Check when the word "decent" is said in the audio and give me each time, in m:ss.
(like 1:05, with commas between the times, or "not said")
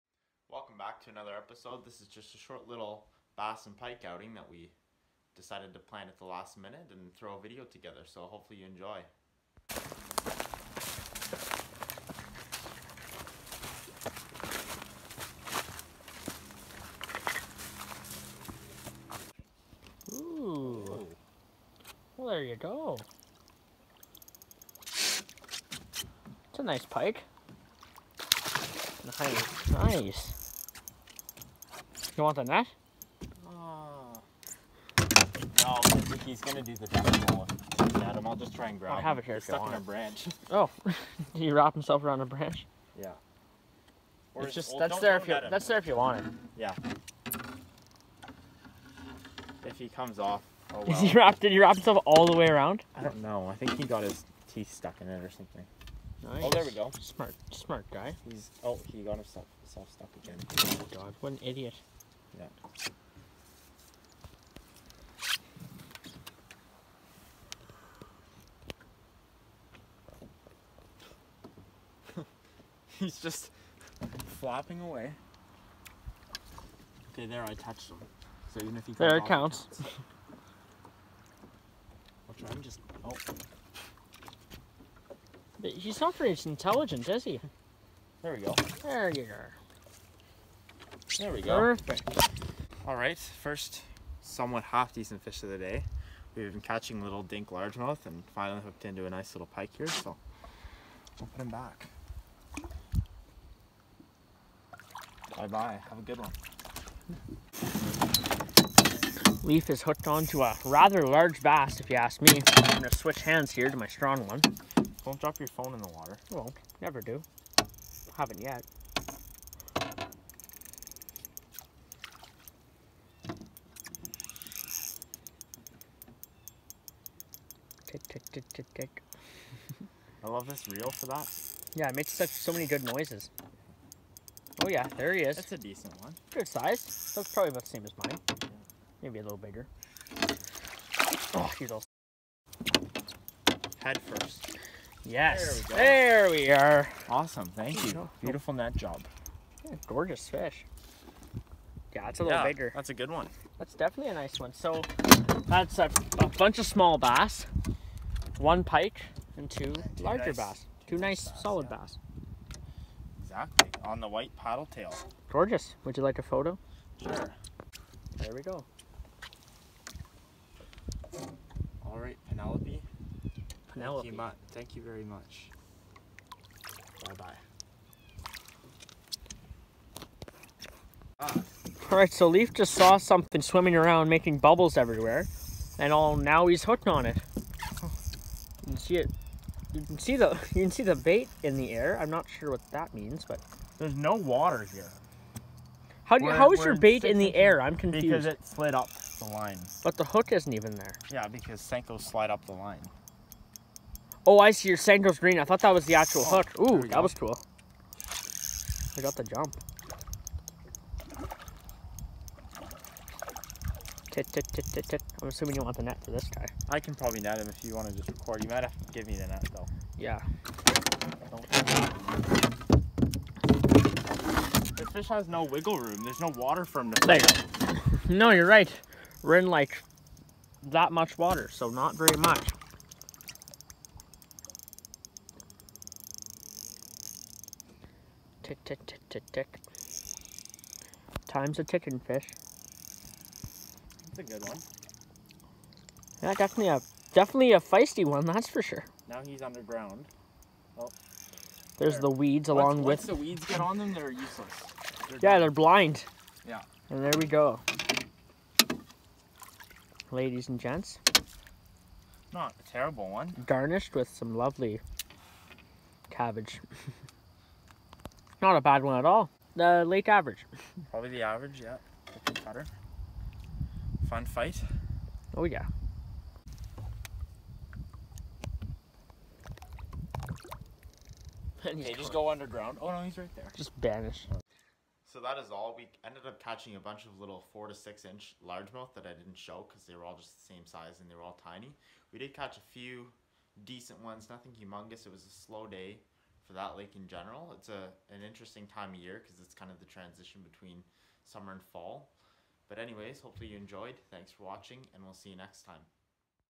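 1:34, 2:15, 4:53.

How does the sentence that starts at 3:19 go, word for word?
But the hook isn't even there.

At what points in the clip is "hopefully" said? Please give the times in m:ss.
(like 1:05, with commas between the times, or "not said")
0:08, 5:03.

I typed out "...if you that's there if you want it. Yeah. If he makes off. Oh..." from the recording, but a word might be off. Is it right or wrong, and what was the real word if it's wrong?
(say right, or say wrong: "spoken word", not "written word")
wrong: "comes", not "makes".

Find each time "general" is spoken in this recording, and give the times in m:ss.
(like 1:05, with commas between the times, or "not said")
4:57.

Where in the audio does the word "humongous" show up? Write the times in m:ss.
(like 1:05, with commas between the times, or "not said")
4:54.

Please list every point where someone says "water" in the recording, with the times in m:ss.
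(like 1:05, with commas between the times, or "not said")
1:55, 3:14, 3:46, 3:51.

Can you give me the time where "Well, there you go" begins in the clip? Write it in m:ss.
0:22.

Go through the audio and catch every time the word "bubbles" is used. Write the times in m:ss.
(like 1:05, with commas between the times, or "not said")
3:04.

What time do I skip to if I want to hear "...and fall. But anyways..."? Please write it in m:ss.
5:01.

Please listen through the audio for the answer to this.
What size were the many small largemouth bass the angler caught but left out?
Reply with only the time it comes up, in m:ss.
4:47.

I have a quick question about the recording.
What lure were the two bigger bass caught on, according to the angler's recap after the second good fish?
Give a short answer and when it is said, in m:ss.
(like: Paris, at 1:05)
white paddle tail, at 2:44.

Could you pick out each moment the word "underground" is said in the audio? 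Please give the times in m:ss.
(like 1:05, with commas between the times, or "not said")
4:09, 4:42.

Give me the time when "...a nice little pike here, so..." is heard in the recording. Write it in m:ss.
1:39.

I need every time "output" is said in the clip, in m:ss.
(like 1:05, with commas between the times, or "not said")
not said.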